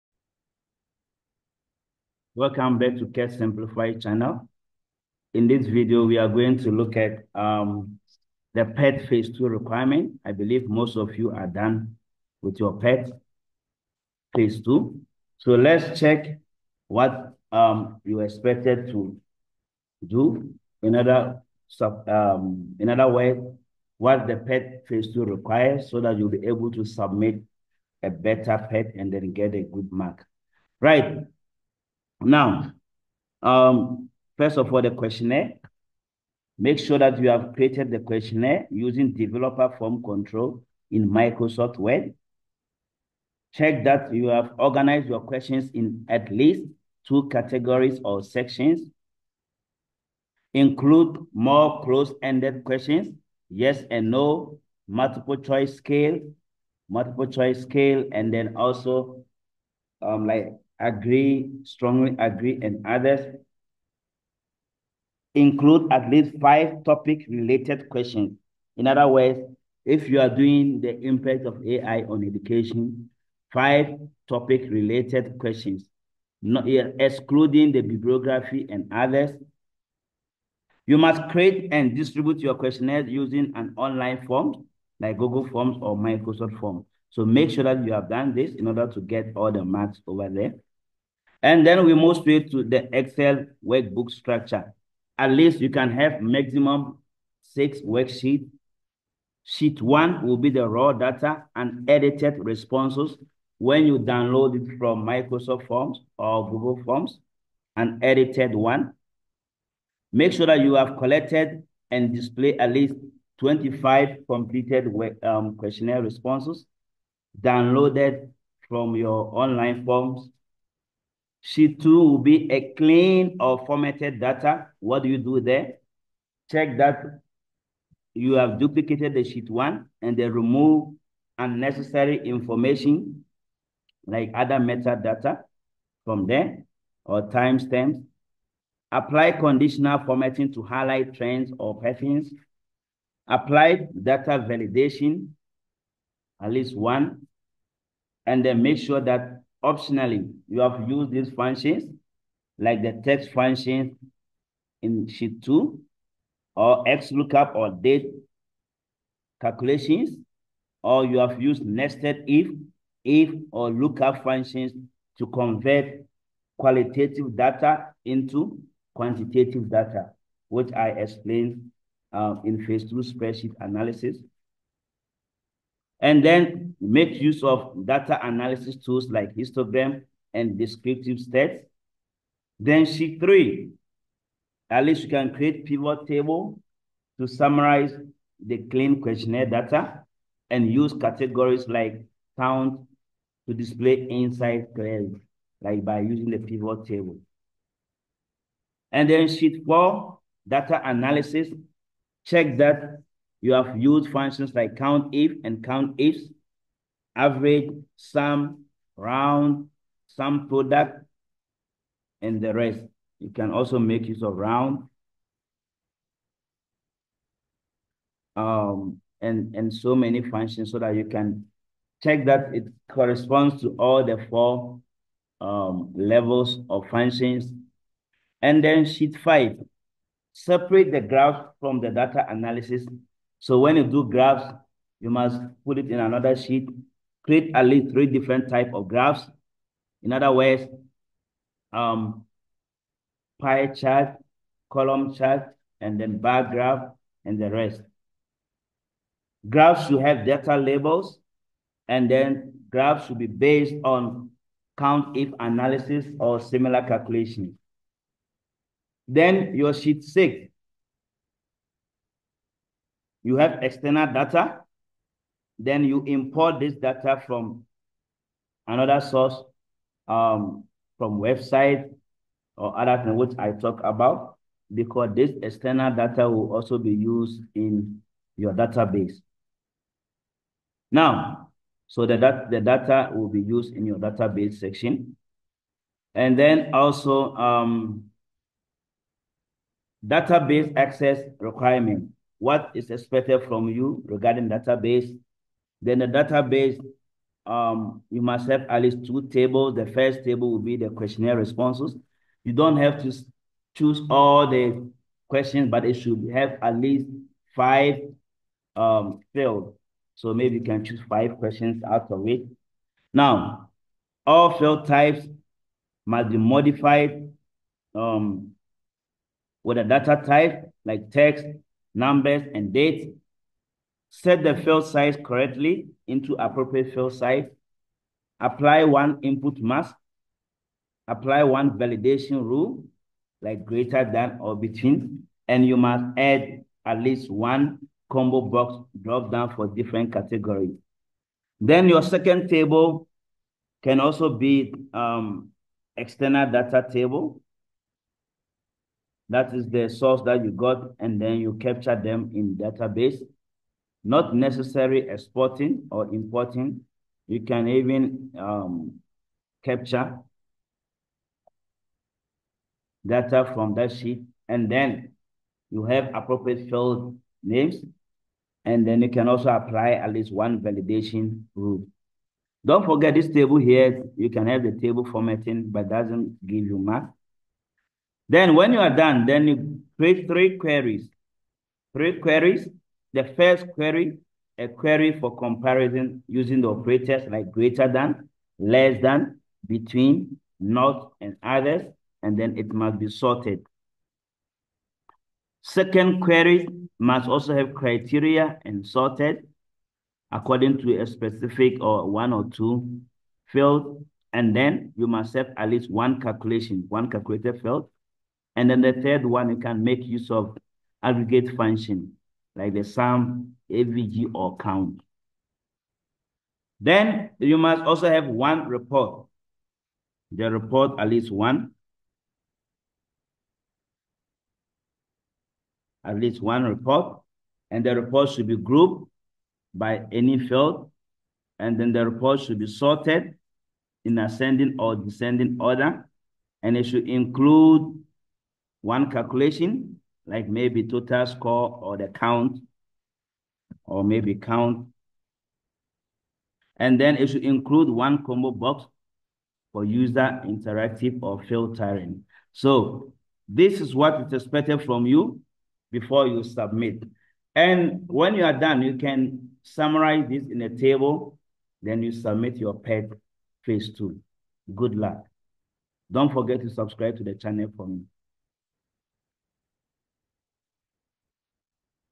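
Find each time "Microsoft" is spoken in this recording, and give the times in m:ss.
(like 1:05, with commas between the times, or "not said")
0:41, 1:25, 1:45.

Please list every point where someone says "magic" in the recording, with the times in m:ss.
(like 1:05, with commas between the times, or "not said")
not said.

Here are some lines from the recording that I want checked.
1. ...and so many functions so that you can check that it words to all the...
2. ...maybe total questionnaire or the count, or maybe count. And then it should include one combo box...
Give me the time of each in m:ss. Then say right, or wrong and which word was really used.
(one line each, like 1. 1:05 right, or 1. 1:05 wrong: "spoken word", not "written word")
1. 3:39 wrong: "corresponds", not "words"
2. 7:20 wrong: "score", not "questionnaire".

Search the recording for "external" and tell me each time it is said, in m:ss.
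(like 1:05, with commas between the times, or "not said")
4:23, 4:35, 5:45.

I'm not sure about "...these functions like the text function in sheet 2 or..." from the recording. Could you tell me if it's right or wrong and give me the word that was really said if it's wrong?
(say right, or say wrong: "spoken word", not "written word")
right.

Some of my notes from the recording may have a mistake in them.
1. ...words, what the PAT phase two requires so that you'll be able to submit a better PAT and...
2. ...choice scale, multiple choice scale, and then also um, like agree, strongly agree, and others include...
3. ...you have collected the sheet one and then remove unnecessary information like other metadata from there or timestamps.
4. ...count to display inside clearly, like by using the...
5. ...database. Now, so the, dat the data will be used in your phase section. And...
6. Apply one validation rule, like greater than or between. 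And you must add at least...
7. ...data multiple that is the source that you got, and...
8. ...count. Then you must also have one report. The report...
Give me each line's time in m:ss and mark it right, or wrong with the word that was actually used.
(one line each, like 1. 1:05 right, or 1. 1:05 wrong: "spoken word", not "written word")
1. 0:23 right
2. 0:55 right
3. 2:08 wrong: "duplicated", not "collected"
4. 3:12 right
5. 4:38 wrong: "database", not "phase"
6. 5:31 right
7. 5:46 wrong: "table", not "multiple"
8. 6:54 right.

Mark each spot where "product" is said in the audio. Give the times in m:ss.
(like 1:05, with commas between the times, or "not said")
3:30.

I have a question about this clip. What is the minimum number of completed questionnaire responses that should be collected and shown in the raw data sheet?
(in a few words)
25.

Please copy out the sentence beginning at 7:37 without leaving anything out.
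And when you are done, you can summarize this in a table, then you submit your PAT phase two.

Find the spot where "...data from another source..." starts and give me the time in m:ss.
4:26.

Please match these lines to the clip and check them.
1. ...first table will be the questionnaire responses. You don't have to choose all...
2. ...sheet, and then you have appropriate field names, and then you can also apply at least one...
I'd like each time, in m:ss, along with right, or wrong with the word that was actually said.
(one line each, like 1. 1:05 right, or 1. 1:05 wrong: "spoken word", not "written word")
1. 4:59 right
2. 6:03 right.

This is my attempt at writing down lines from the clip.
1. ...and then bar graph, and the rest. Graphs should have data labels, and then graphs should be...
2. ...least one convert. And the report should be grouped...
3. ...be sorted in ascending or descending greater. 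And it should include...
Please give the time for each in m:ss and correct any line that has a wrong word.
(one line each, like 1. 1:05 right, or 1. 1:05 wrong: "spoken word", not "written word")
1. 4:05 right
2. 7:06 wrong: "report", not "convert"
3. 7:12 wrong: "order", not "greater".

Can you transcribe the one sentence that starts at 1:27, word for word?
So make sure that you have done this in order to get all the marks over there.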